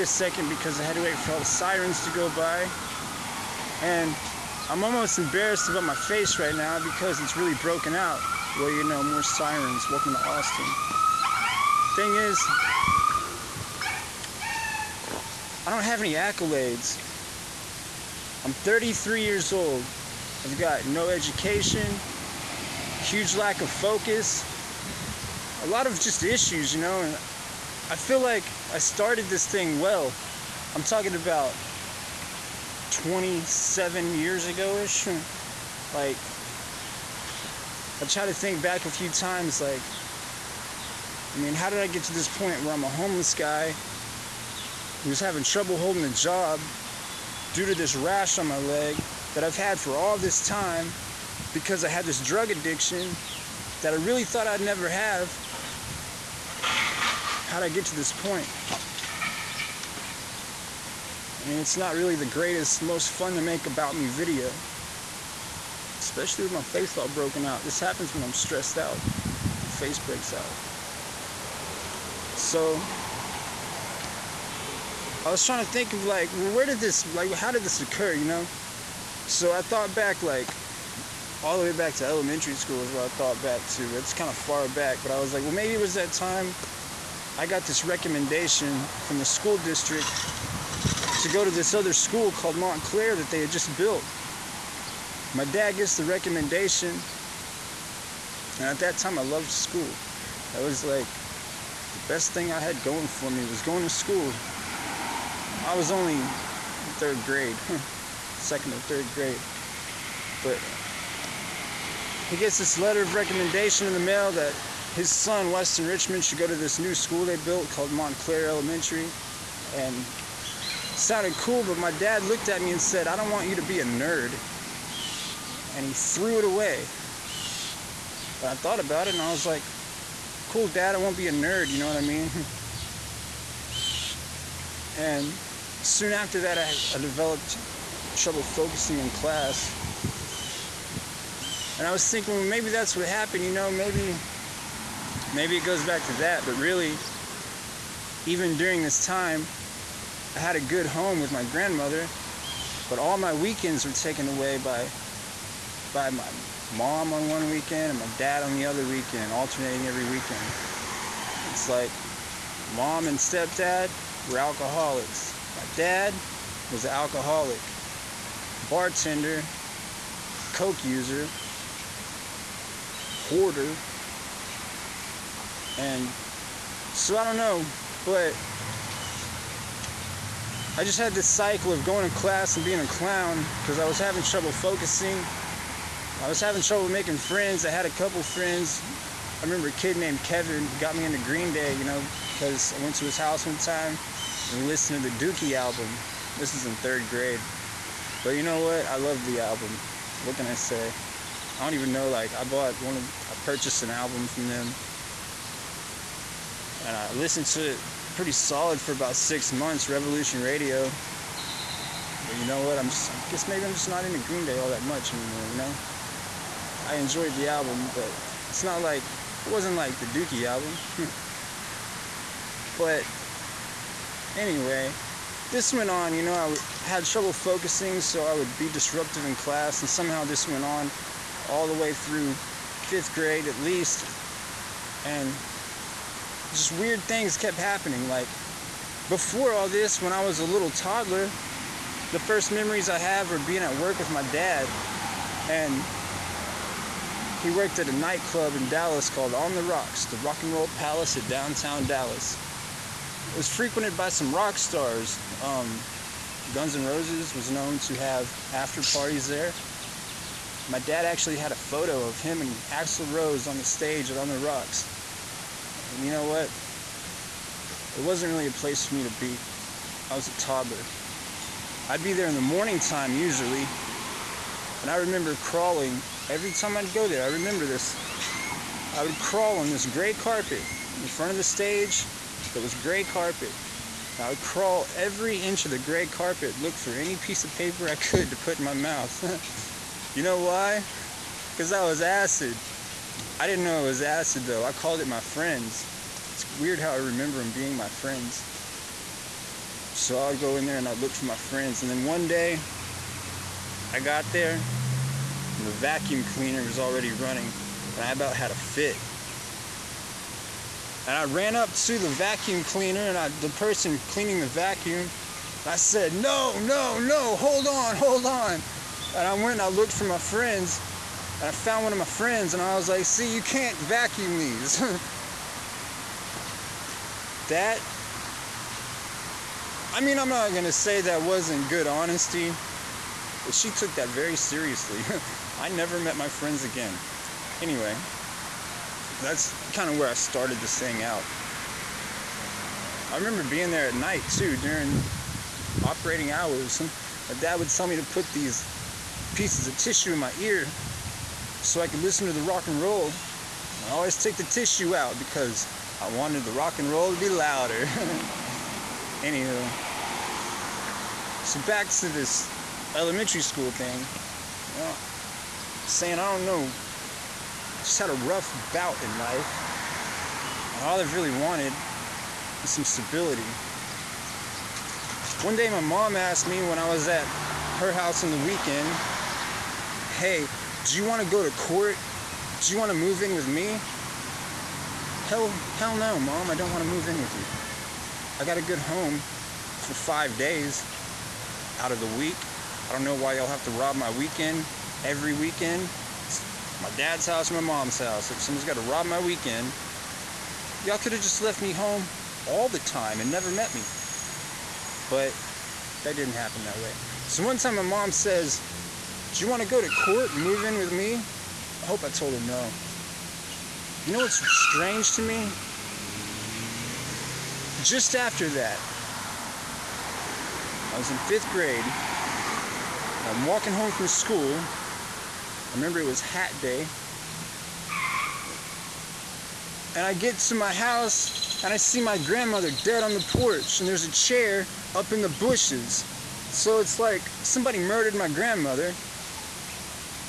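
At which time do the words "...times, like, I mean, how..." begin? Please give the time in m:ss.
0:39.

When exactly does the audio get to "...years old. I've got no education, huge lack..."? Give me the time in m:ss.
0:19.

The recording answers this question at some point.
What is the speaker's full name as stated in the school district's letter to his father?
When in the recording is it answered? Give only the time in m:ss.
1:55.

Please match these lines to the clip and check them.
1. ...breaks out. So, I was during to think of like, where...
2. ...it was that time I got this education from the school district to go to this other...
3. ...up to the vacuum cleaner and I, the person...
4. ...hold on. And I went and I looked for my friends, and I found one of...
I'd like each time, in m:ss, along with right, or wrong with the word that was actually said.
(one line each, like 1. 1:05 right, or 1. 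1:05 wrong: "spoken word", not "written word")
1. 1:09 wrong: "trying", not "during"
2. 1:25 wrong: "recommendation", not "education"
3. 5:11 right
4. 5:17 right.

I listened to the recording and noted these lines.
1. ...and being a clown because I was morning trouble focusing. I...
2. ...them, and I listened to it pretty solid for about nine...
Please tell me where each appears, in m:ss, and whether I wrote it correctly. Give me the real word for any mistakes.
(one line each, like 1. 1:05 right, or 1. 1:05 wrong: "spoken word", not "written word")
1. 3:02 wrong: "having", not "morning"
2. 3:24 wrong: "six", not "nine".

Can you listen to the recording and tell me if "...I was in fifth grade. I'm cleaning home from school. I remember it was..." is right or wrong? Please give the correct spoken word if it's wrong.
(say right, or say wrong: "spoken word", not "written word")
wrong: "walking", not "cleaning".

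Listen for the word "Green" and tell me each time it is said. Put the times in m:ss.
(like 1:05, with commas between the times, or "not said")
3:11, 3:34.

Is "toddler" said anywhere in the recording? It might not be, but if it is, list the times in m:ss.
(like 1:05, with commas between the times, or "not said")
4:00, 4:30.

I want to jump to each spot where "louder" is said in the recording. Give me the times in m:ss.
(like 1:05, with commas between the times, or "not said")
5:57.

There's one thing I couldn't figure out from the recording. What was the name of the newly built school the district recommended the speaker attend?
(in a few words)
Montclair Elementary.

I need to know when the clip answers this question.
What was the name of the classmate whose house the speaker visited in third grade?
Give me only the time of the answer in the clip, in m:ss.
3:10.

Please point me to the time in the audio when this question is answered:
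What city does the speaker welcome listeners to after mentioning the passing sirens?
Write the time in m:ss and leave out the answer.
0:10.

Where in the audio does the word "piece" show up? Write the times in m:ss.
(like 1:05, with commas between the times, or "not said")
4:47, 5:49.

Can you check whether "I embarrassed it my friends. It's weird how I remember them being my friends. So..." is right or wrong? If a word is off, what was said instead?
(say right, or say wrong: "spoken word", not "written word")
wrong: "called", not "embarrassed".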